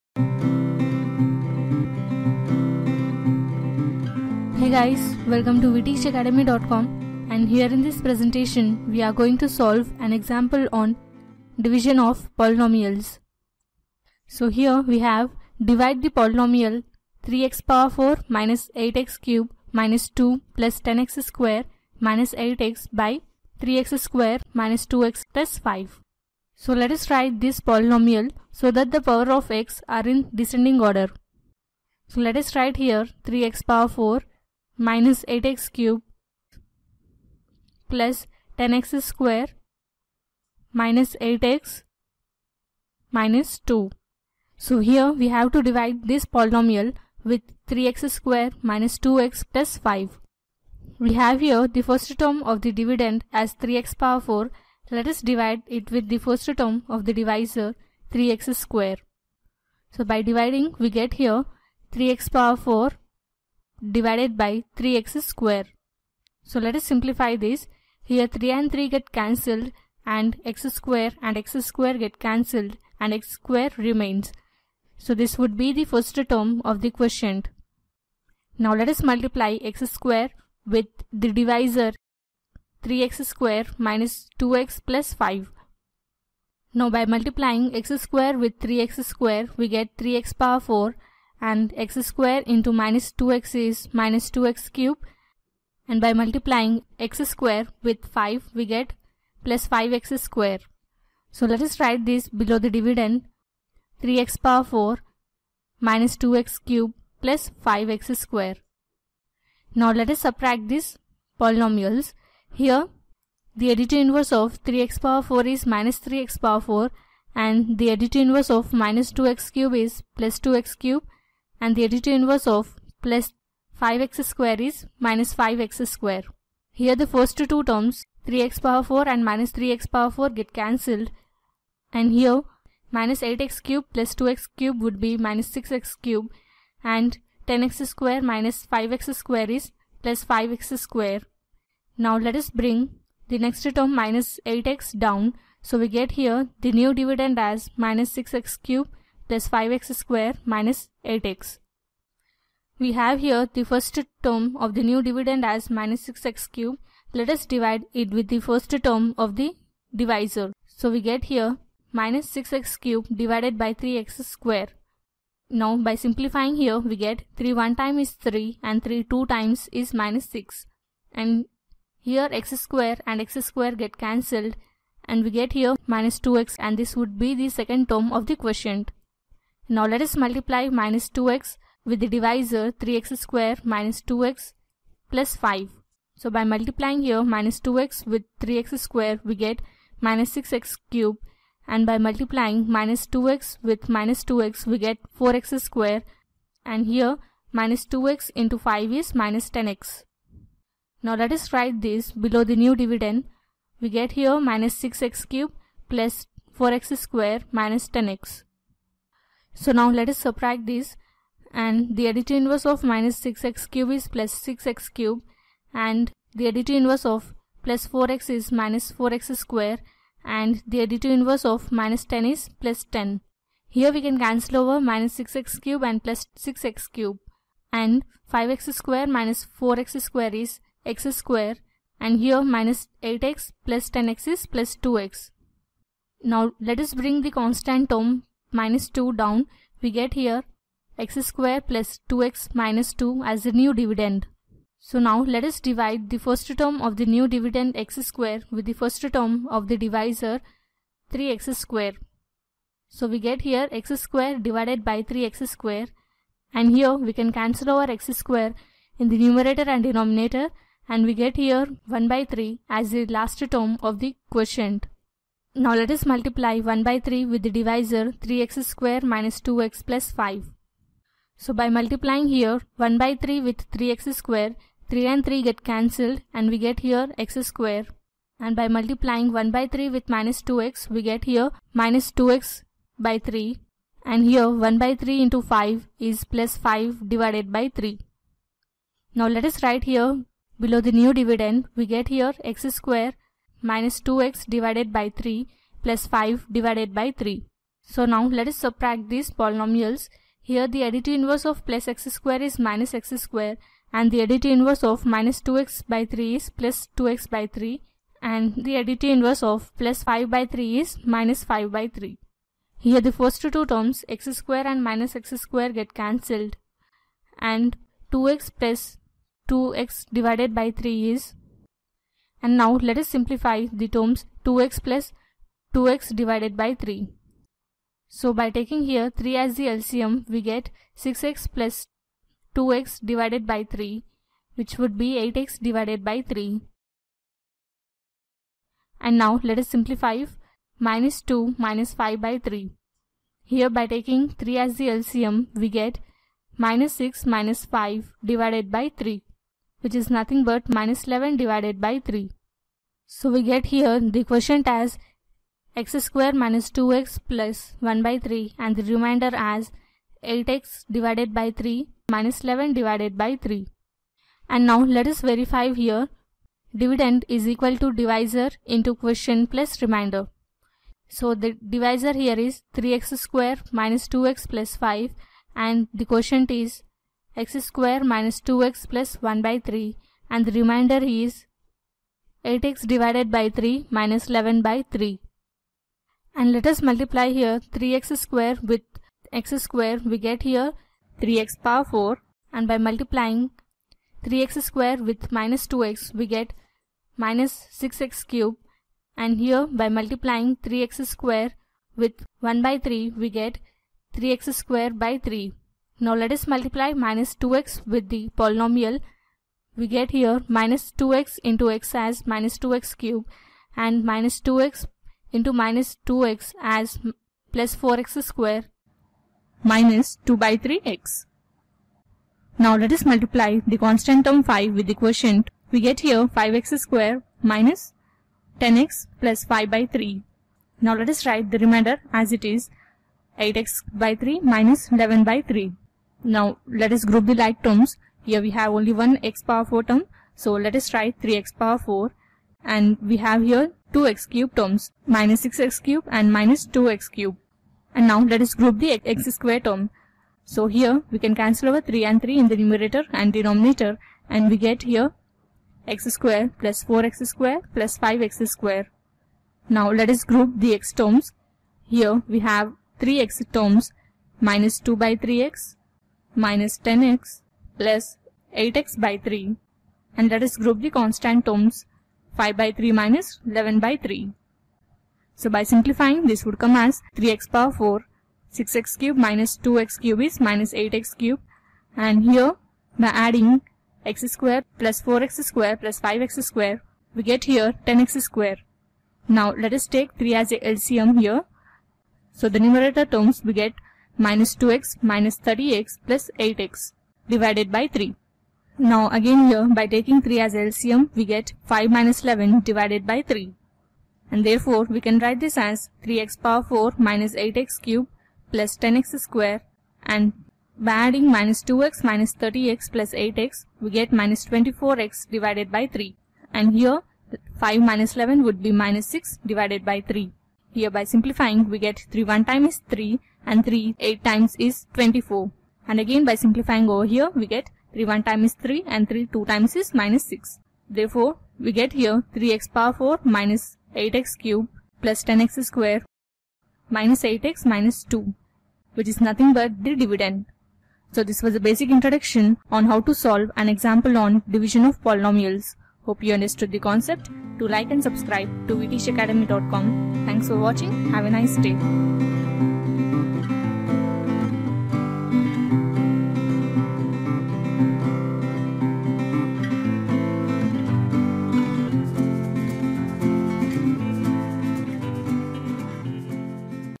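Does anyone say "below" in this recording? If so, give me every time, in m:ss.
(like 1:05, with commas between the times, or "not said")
1:42, 3:22, 4:50.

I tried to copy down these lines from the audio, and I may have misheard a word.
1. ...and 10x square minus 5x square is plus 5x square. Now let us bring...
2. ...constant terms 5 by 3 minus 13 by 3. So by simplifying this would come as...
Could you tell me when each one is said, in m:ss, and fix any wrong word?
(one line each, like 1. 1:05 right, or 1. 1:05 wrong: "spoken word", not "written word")
1. 2:16 right
2. 7:50 wrong: "11", not "13".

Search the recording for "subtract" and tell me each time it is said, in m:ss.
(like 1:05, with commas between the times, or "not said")
1:50, 3:30, 4:58.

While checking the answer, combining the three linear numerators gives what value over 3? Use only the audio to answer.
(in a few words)
-24x.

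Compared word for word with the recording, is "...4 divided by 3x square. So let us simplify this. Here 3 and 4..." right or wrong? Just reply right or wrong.
wrong.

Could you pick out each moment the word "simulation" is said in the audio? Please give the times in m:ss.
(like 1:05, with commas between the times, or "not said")
not said.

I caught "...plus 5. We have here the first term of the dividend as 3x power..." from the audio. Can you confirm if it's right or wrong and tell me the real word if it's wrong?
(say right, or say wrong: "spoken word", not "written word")
right.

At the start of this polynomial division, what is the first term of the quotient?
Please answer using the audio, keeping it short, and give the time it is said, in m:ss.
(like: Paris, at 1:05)
x^2, at 1:13.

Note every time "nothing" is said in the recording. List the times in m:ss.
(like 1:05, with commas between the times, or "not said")
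5:50, 8:59.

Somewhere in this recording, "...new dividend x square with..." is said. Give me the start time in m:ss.
4:07.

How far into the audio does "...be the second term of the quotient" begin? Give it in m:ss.
2:57.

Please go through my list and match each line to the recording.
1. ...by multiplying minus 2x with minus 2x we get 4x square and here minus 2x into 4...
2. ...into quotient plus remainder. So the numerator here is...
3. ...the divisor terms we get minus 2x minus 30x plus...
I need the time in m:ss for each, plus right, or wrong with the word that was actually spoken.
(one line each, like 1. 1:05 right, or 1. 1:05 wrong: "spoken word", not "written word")
1. 3:11 wrong: "5", not "4"
2. 6:08 wrong: "divisor", not "numerator"
3. 8:12 wrong: "numerator", not "divisor".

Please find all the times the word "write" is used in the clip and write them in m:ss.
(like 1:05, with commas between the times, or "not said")
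0:27, 0:32, 1:41, 3:21, 4:49, 7:11, 7:20, 8:25.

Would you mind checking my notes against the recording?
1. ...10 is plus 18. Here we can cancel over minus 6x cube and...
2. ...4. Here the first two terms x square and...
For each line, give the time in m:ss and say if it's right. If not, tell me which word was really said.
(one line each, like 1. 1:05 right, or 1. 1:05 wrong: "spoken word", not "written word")
1. 3:42 wrong: "10", not "18"
2. 5:11 wrong: "3", not "4".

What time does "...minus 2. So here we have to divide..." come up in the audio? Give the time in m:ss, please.
0:43.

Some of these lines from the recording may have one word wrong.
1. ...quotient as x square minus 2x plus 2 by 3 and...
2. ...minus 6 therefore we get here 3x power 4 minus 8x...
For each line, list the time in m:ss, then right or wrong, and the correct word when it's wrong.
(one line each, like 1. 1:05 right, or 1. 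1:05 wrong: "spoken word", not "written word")
1. 5:54 wrong: "1", not "2"
2. 8:50 right.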